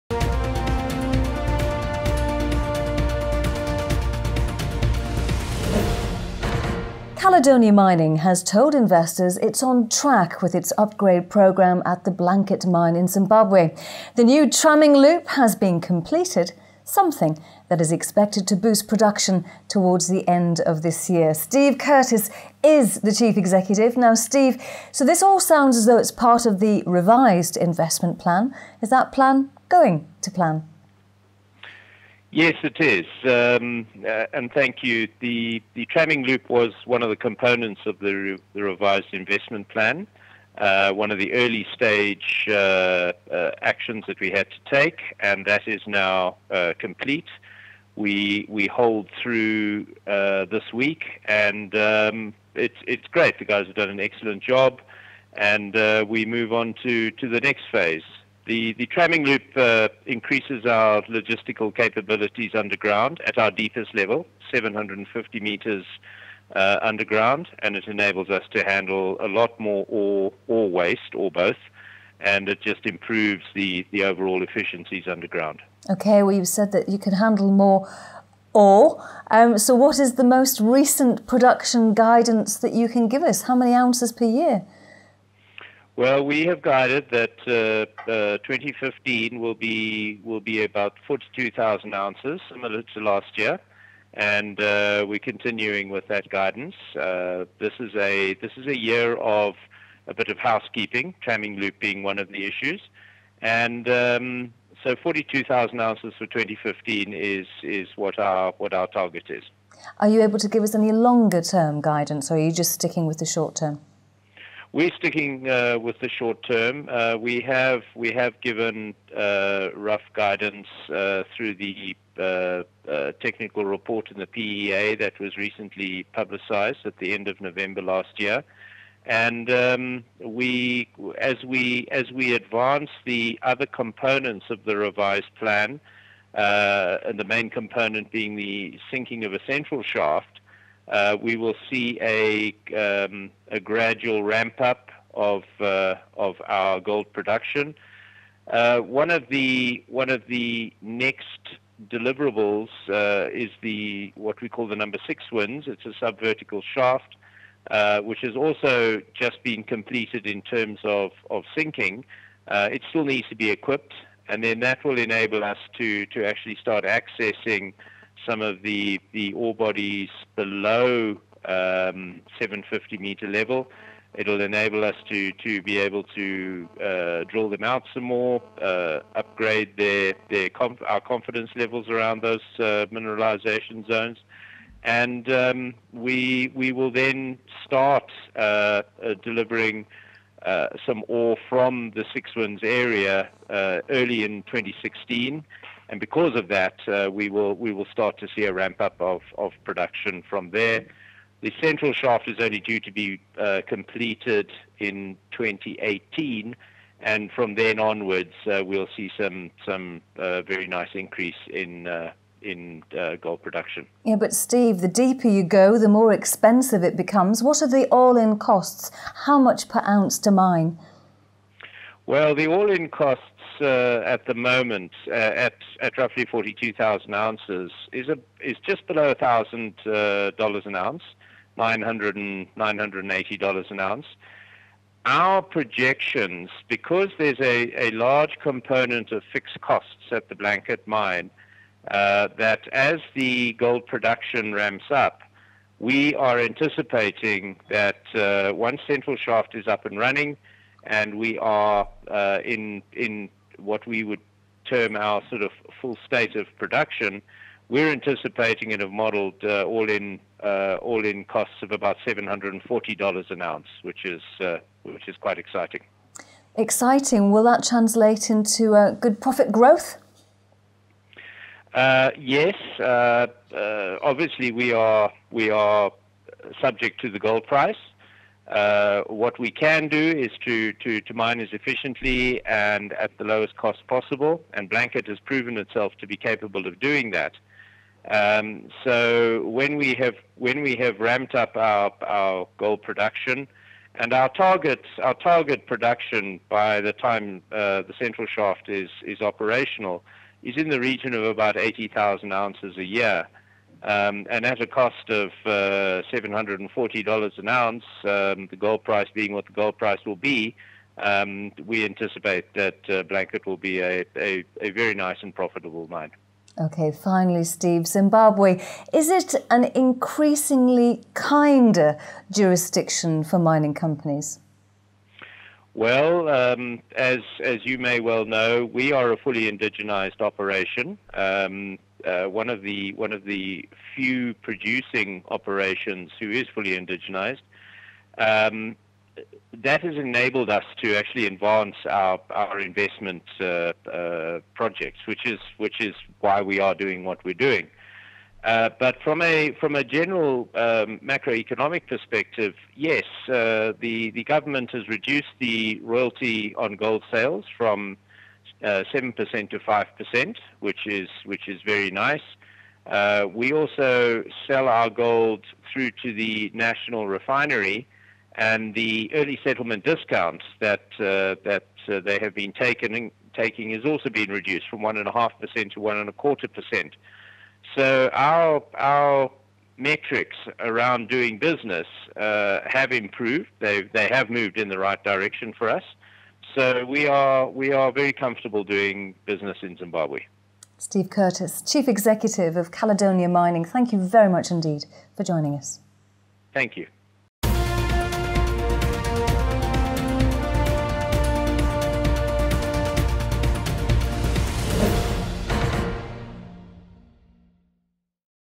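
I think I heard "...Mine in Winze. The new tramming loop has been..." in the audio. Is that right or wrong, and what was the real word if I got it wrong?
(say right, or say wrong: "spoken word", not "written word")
wrong: "Zimbabwe", not "Winze".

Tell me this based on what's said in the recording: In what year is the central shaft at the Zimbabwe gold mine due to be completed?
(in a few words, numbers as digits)
2018.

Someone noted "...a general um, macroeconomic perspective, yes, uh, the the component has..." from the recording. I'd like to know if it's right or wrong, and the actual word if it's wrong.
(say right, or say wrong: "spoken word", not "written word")
wrong: "government", not "component".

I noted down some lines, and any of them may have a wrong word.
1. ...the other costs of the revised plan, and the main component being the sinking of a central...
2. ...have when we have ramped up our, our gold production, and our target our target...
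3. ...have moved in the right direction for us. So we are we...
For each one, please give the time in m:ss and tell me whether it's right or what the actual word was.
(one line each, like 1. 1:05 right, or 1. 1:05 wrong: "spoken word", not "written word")
1. 2:13 wrong: "components", not "costs"
2. 4:49 right
3. 6:24 right.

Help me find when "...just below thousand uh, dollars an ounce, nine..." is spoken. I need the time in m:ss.
3:48.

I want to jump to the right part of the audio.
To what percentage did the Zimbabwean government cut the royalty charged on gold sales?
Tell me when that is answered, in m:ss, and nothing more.
5:59.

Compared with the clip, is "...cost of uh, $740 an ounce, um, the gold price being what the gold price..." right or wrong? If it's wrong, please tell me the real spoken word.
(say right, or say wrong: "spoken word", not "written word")
right.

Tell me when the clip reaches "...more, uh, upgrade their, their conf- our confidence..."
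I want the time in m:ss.
2:58.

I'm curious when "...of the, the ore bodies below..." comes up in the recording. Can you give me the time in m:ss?
2:48.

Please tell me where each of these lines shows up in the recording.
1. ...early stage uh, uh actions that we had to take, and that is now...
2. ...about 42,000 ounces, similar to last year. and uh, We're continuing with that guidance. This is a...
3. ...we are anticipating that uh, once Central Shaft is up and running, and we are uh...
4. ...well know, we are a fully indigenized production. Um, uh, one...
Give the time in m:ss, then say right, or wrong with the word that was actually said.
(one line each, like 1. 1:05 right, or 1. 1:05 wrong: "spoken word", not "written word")
1. 0:41 right
2. 1:30 right
3. 4:05 right
4. 5:28 wrong: "operation", not "production".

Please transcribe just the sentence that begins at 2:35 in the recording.
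It's a subvertical shaft, which has also just been completed in terms of of sinking.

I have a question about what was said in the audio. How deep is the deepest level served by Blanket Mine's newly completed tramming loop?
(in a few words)
750 meters.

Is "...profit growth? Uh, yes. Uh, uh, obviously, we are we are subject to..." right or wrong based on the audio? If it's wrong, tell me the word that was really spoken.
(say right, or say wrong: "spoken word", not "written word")
right.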